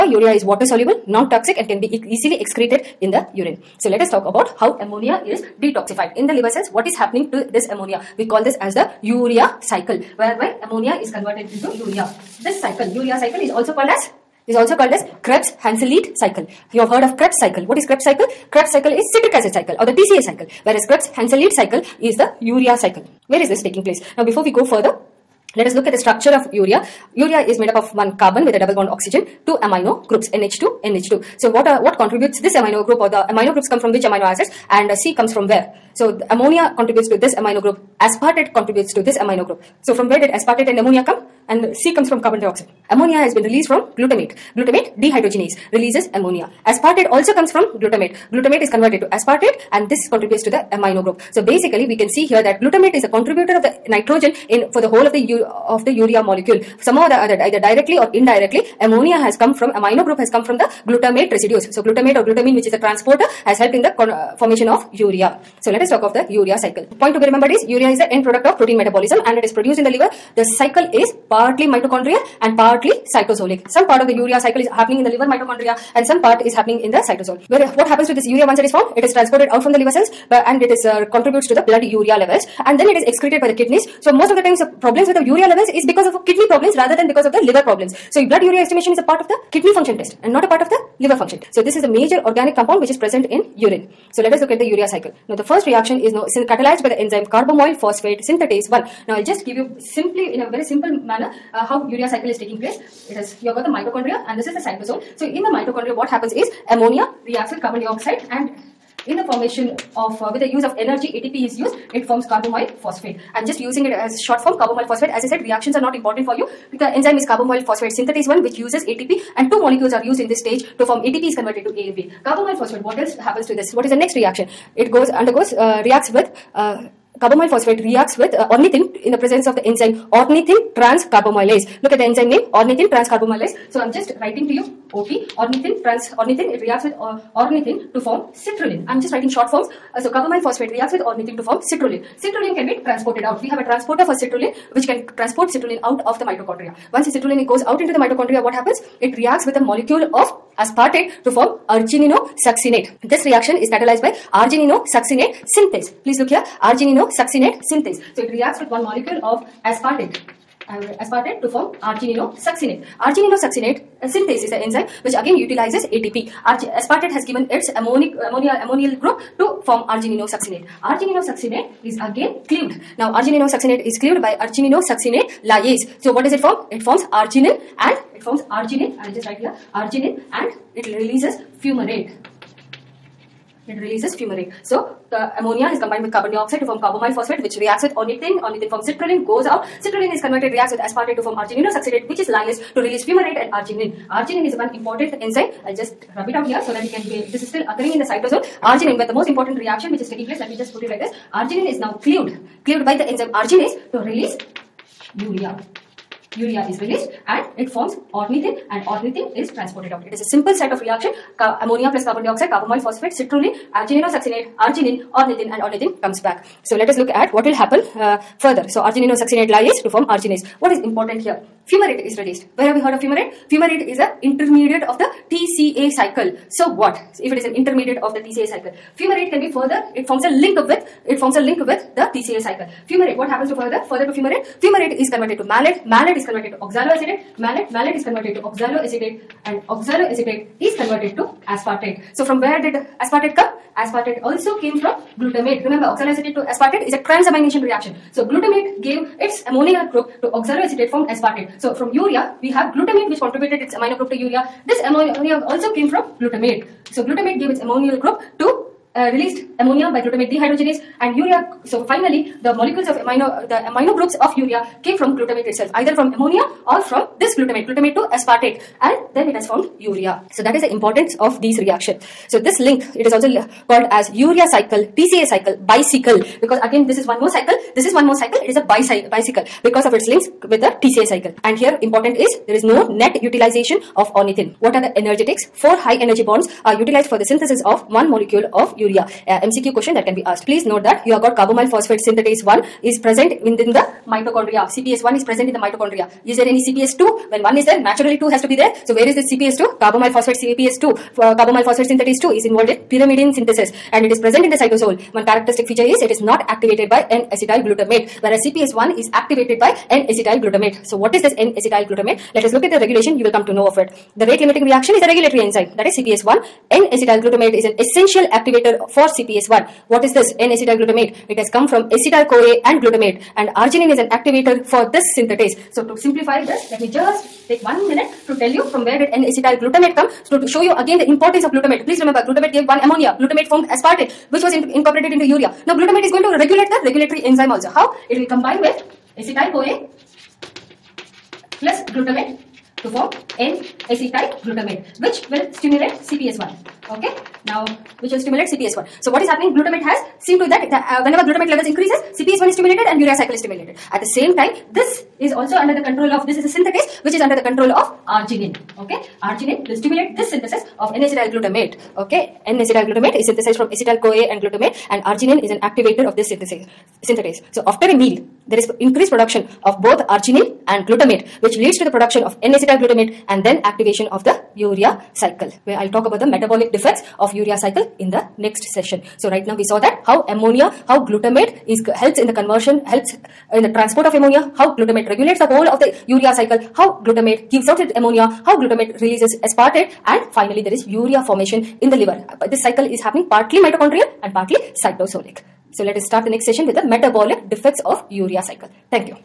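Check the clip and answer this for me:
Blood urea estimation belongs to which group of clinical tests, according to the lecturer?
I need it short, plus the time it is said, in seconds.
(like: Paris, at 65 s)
Kidney function test, at 89 s.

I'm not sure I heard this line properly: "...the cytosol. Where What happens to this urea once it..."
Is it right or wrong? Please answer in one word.
right.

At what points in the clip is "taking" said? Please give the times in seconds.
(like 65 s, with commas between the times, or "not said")
23 s, 102 s, 200 s.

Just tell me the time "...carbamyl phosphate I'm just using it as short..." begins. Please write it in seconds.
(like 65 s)
112 s.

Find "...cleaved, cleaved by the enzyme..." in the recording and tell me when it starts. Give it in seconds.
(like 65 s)
202 s.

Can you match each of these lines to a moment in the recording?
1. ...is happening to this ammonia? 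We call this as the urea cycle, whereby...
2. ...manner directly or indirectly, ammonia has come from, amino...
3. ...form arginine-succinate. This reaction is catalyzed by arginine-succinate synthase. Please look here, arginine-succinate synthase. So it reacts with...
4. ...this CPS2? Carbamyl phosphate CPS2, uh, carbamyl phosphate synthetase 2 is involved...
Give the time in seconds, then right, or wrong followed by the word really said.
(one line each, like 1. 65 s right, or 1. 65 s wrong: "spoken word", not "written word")
1. 6 s right
2. 57 s wrong: "either", not "manner"
3. 151 s right
4. 299 s right.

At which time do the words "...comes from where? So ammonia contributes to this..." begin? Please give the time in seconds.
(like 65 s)
35 s.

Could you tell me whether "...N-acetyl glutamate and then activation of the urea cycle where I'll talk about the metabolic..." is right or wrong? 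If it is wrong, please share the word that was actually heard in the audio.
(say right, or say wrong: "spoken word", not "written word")
right.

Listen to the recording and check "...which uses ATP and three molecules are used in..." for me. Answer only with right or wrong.
wrong.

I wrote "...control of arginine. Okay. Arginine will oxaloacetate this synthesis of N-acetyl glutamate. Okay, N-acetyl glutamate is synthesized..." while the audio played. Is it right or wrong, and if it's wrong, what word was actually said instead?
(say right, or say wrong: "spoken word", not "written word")
wrong: "stimulate", not "oxaloacetate".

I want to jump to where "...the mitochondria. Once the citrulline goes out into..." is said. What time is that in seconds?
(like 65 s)
146 s.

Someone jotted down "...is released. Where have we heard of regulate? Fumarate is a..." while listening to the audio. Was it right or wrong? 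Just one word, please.
wrong.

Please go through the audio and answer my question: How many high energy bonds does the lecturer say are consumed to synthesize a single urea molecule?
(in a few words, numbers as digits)
4.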